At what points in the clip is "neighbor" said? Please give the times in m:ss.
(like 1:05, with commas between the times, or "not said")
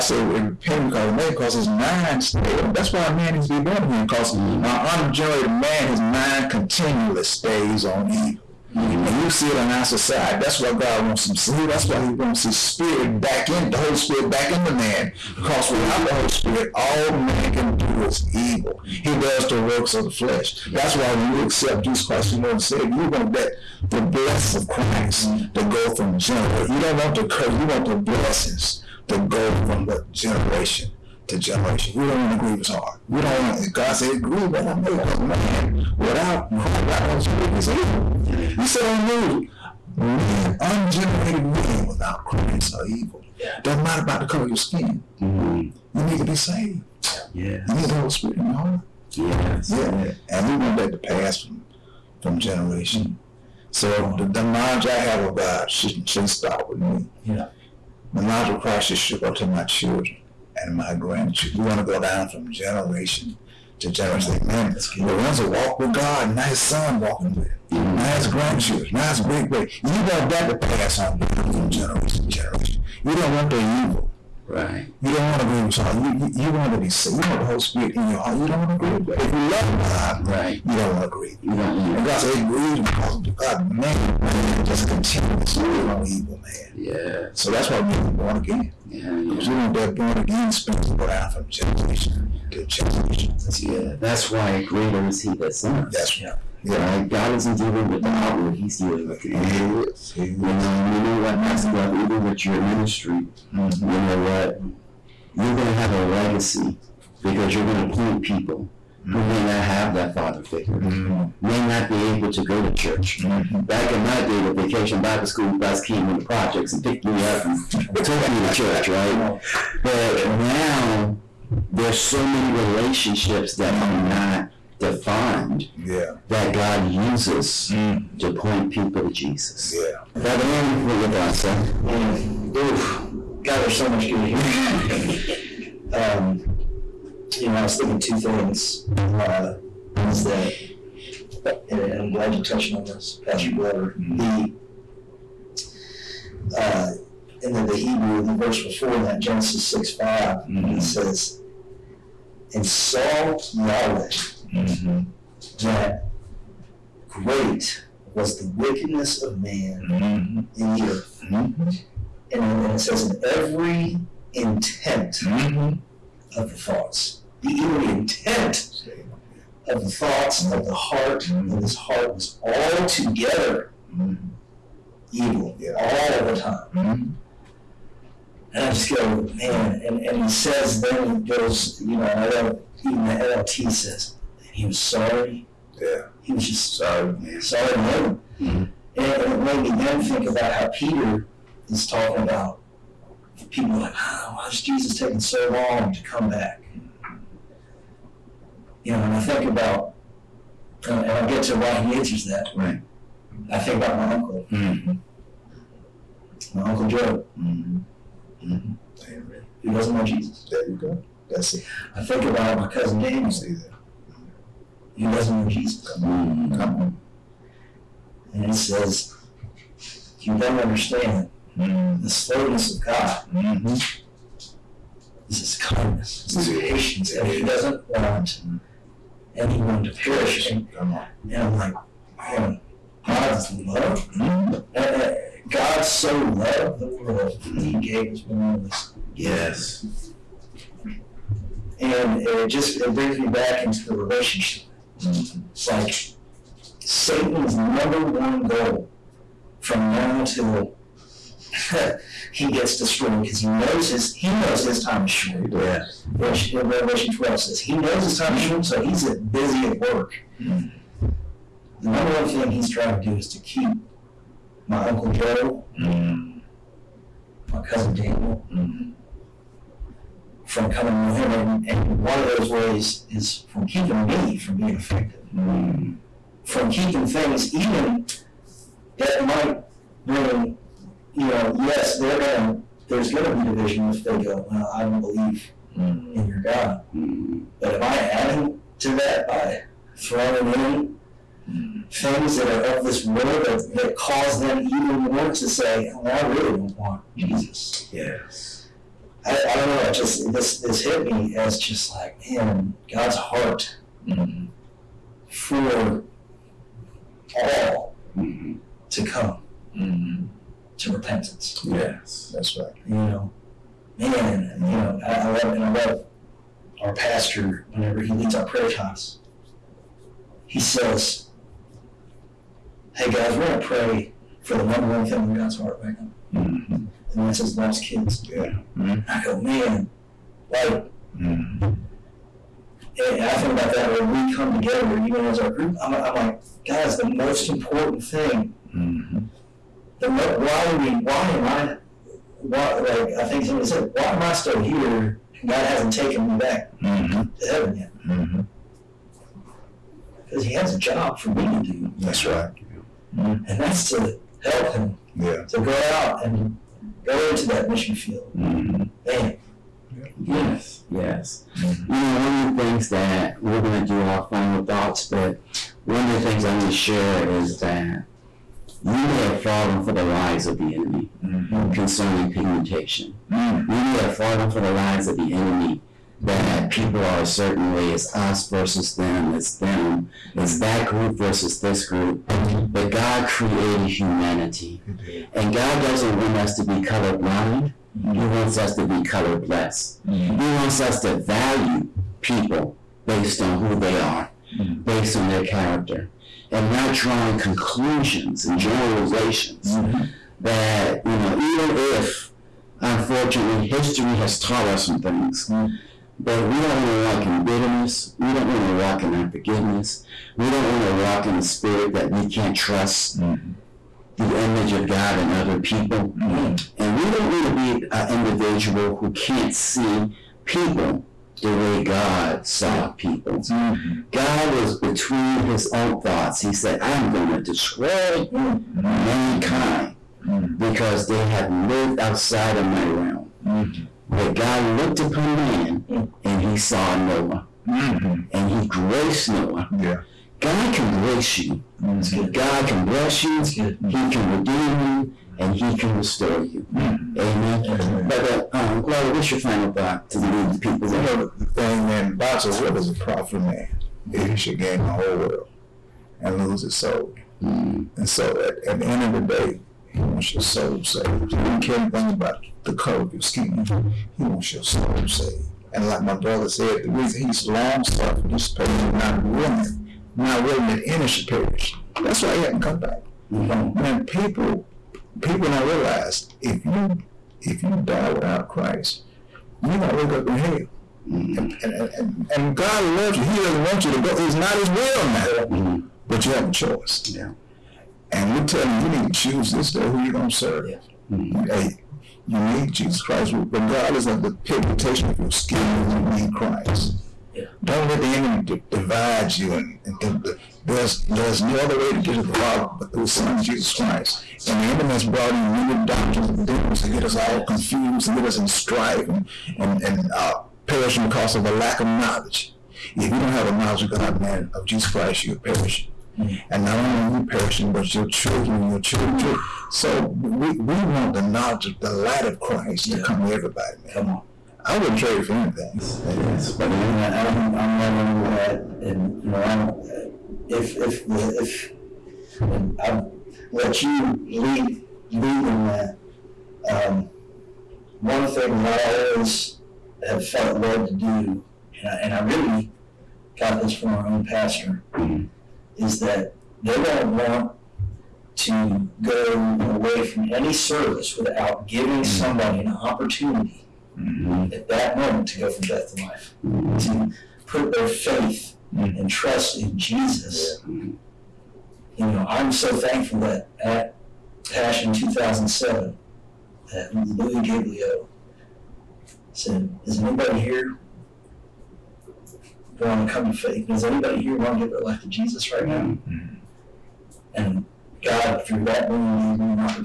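not said.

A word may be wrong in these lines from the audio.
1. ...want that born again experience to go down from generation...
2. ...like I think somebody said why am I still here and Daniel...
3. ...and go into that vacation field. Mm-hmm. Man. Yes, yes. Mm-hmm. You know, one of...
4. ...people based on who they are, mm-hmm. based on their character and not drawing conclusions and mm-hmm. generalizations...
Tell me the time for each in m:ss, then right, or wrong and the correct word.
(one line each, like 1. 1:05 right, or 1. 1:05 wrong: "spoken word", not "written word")
1. 1:29 right
2. 5:42 wrong: "God", not "Daniel"
3. 5:56 wrong: "mission", not "vacation"
4. 6:32 right.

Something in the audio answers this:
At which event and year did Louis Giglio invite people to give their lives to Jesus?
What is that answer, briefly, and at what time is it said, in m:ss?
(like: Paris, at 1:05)
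Passion 2007, at 9:24.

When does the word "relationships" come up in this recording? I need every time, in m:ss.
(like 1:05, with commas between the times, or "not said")
2:02, 4:03.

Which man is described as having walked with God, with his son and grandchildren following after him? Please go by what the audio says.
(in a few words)
Lorenzo.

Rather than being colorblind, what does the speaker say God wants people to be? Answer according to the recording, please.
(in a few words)
Color blessed.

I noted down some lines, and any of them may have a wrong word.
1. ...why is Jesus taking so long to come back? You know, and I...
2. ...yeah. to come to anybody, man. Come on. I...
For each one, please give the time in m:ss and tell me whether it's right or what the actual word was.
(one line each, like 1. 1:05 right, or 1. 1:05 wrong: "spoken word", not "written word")
1. 3:14 right
2. 8:42 wrong: "everybody", not "anybody".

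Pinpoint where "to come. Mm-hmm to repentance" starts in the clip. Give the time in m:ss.
5:08.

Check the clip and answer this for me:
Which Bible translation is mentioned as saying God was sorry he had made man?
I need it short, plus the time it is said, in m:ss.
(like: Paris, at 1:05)
NLT, at 3:03.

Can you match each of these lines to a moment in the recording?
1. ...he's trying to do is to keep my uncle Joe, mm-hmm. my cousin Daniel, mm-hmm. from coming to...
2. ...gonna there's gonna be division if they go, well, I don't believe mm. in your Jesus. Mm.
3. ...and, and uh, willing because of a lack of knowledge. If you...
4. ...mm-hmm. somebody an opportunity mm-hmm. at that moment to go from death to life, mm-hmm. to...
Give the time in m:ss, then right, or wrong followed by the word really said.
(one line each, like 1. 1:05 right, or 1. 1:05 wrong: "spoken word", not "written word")
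1. 4:22 right
2. 4:42 wrong: "God", not "Jesus"
3. 8:29 wrong: "perishing", not "willing"
4. 9:12 right.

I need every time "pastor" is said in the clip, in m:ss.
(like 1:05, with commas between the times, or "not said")
1:41, 2:23, 5:16, 9:04.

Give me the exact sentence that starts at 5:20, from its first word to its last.
He says, "Hey guys, we're going to pray for the number one thing on God's heart right now, mm-hmm.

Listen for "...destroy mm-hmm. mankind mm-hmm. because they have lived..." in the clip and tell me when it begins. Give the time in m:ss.
7:07.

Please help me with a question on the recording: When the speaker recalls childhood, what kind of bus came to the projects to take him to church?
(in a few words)
Vacation Bible school bus.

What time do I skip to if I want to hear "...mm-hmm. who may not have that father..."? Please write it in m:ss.
1:49.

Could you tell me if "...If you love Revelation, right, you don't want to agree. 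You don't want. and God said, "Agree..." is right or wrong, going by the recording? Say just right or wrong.
wrong.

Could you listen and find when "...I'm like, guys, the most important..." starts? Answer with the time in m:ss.
5:35.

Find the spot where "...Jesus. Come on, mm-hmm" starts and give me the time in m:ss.
3:35.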